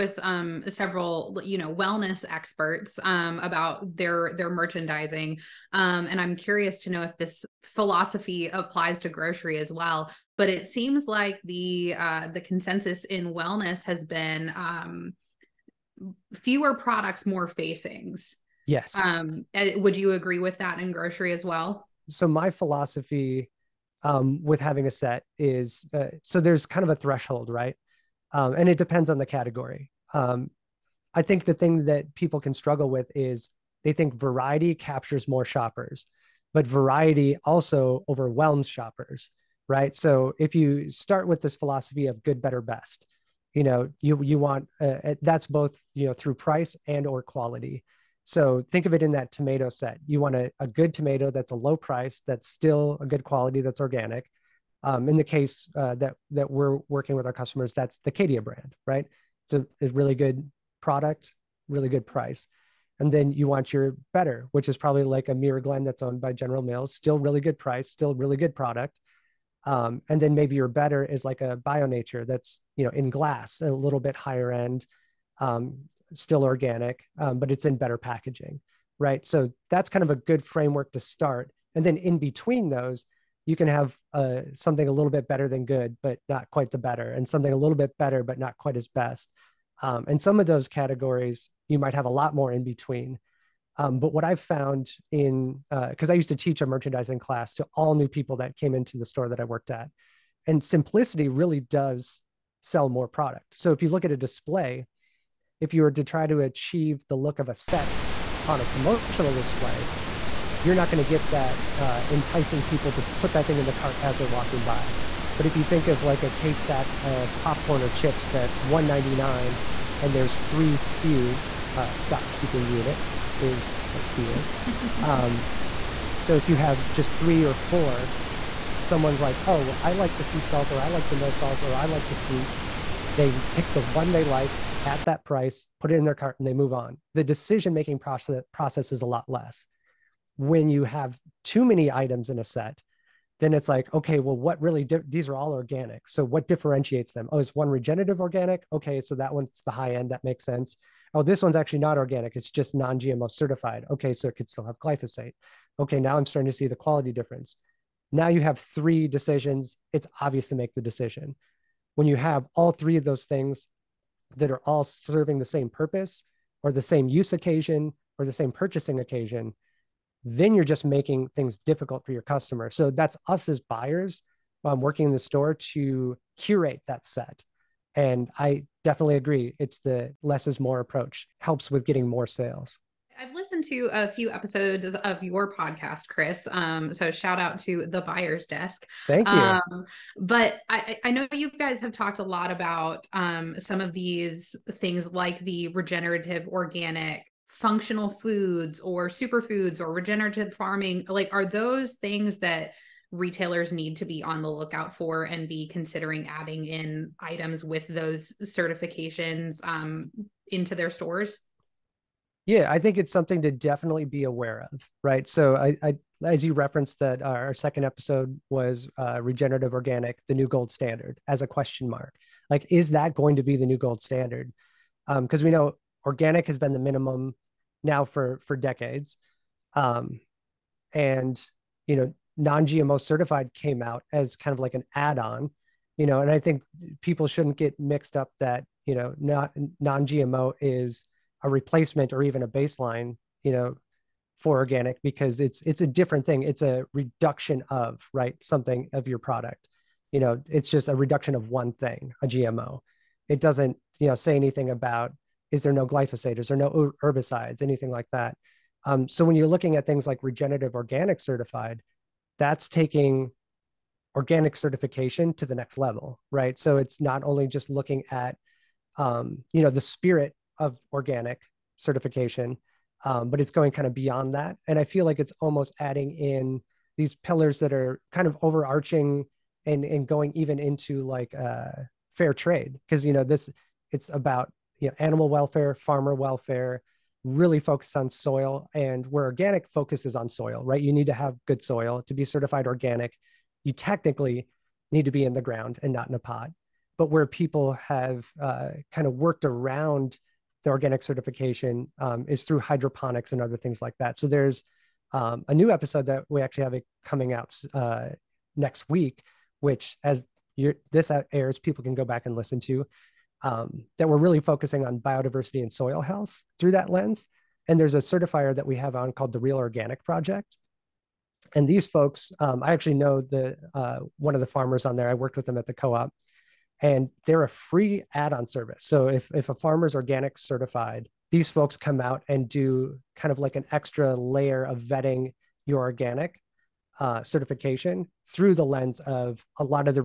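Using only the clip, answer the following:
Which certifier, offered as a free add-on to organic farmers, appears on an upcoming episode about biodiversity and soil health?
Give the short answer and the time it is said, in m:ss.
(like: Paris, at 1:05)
Real Organic Project, at 5:19.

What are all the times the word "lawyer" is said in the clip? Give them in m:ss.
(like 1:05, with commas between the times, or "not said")
not said.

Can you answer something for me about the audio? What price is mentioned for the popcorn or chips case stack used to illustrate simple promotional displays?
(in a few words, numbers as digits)
199.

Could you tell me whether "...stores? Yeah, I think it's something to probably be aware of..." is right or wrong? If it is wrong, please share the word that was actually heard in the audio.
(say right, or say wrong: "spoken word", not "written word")
wrong: "definitely", not "probably".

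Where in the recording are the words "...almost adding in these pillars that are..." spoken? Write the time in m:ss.
4:35.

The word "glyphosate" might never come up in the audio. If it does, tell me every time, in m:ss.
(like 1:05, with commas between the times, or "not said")
2:34, 4:15.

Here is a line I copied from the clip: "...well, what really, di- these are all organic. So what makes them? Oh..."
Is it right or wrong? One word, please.
wrong.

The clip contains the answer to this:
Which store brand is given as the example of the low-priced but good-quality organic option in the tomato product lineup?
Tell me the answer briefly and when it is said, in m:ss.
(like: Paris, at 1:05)
Cadia, at 0:58.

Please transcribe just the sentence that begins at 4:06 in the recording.
It's a reduction of right something of your product.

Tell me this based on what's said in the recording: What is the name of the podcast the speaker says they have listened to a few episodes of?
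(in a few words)
The Buyer's Desk.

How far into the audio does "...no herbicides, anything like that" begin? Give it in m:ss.
4:16.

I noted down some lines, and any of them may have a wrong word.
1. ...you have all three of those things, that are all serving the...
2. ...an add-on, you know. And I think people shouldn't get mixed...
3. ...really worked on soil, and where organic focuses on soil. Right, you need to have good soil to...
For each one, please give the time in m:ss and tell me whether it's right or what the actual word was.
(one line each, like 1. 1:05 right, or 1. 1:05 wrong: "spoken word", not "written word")
1. 2:42 right
2. 3:54 right
3. 4:47 wrong: "focused", not "worked".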